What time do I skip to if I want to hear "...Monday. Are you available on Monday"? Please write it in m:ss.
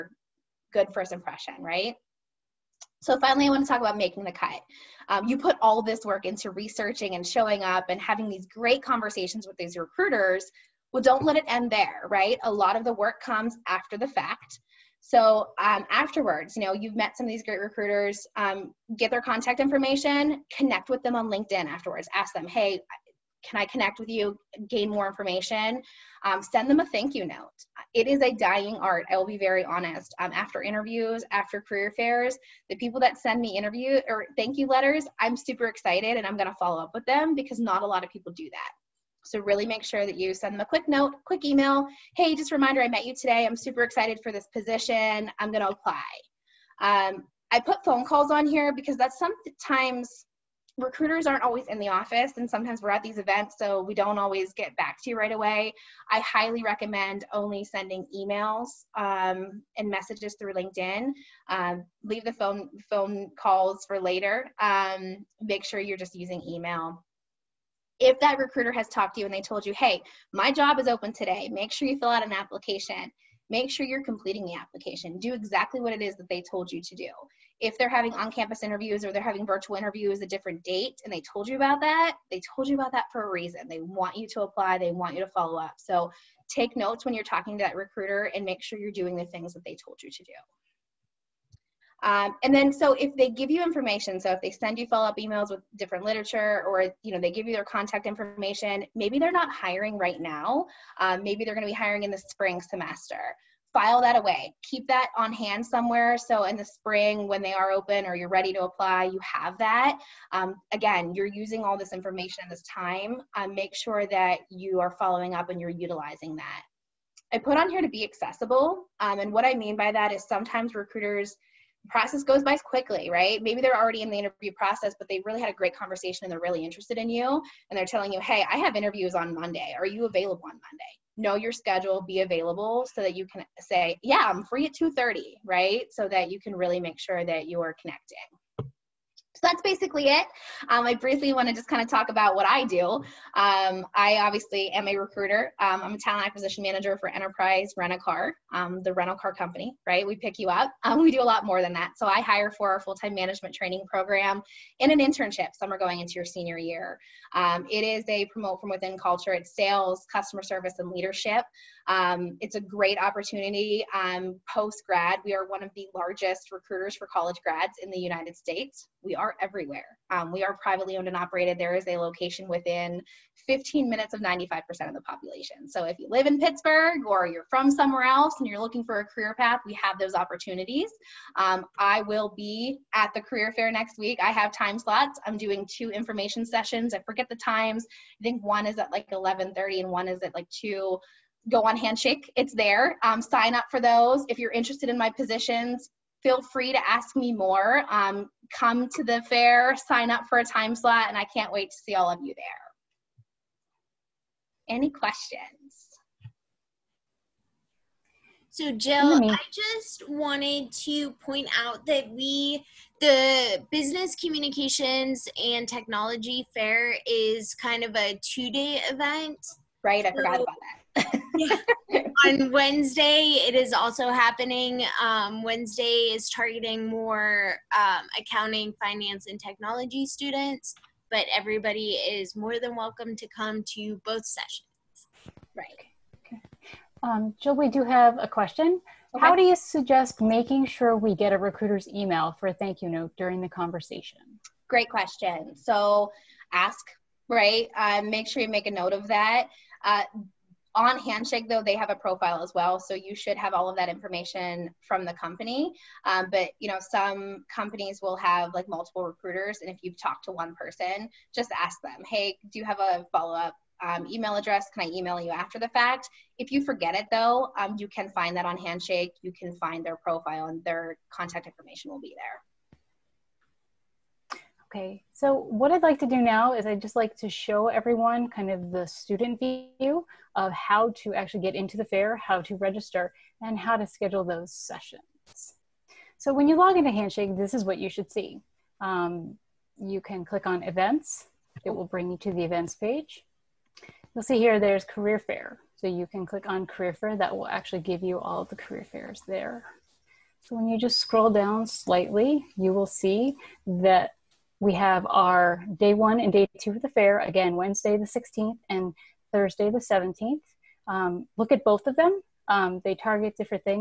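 2:09.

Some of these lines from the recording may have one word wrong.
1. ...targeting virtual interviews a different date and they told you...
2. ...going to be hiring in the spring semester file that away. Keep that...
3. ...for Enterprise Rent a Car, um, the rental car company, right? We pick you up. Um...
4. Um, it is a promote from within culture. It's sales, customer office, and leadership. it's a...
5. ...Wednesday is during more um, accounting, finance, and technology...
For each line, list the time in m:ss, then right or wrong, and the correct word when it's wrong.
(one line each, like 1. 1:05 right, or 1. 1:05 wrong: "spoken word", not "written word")
1. 1:19 wrong: "having", not "targeting"
2. 1:41 right
3. 2:26 right
4. 2:37 wrong: "service", not "office"
5. 3:45 wrong: "targeting", not "during".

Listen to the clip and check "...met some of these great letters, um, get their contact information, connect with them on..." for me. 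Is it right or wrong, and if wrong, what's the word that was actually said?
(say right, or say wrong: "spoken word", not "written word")
wrong: "recruiters", not "letters".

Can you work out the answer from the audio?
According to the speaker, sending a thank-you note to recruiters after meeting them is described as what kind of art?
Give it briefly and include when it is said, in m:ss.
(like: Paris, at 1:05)
A dying art, at 0:28.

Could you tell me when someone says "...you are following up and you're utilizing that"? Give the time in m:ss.
1:54.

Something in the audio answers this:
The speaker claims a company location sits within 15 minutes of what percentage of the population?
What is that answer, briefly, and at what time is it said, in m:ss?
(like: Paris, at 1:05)
95%, at 2:54.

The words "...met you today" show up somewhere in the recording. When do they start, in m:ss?
0:42.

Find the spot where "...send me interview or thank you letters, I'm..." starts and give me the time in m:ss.
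0:33.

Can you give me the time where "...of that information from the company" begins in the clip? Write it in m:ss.
4:13.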